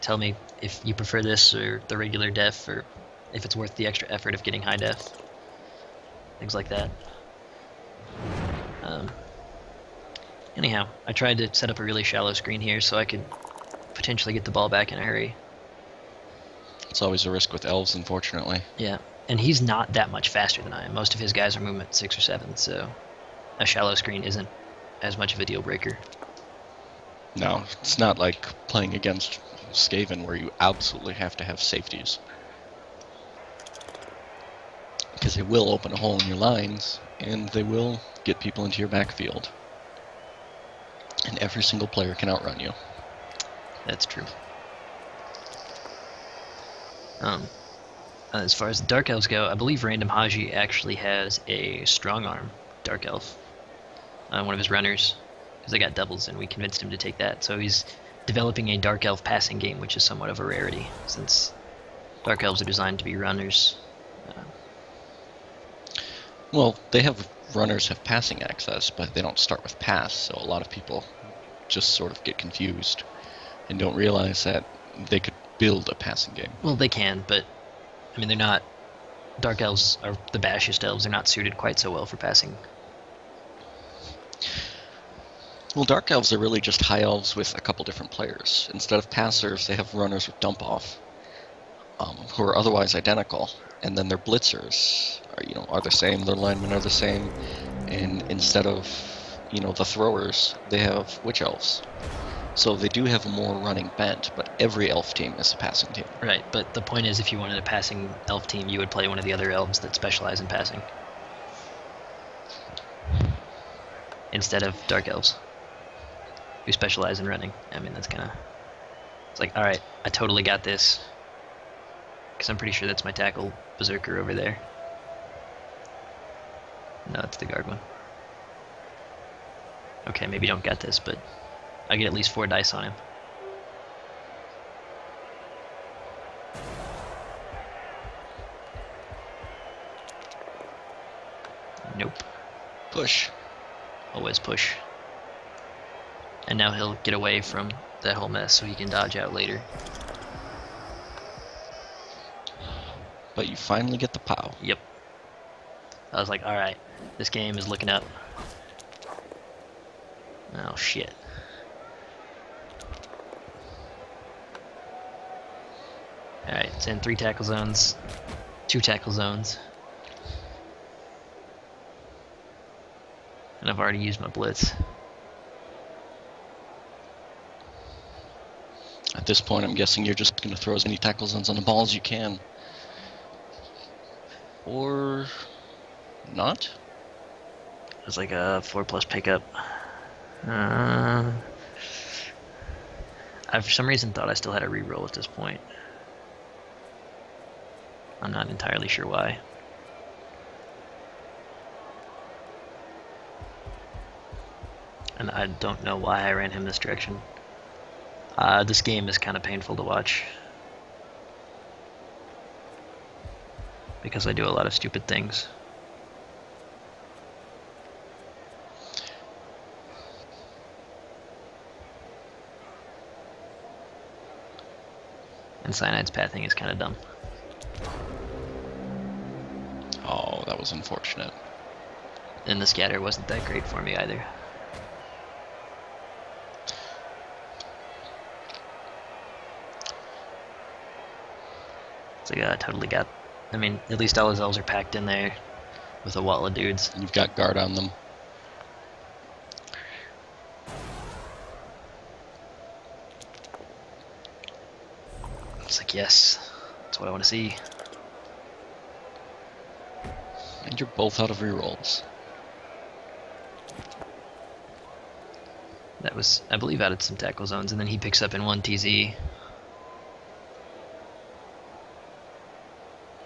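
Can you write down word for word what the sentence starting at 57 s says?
So he's developing a Dark Elf passing game, which is somewhat of a rarity, since Dark Elves are designed to be runners.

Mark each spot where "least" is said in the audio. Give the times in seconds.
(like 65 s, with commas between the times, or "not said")
132 s, 244 s.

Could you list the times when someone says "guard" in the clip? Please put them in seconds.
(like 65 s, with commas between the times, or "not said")
127 s, 247 s.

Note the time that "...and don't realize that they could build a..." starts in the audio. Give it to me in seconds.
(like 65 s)
73 s.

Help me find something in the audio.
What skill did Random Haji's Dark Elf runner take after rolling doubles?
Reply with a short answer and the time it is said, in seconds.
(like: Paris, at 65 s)
Strong arm, at 51 s.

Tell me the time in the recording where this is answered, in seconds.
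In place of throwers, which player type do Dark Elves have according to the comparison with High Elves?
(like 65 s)
101 s.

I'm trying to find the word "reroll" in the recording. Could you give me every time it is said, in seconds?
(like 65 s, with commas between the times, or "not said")
194 s, 261 s.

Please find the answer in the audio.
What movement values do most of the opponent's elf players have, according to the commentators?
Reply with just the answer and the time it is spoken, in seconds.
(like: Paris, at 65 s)
6 or 7, at 21 s.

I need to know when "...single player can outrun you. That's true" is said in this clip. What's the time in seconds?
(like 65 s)
41 s.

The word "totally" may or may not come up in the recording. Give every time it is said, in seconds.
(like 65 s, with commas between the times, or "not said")
120 s, 242 s.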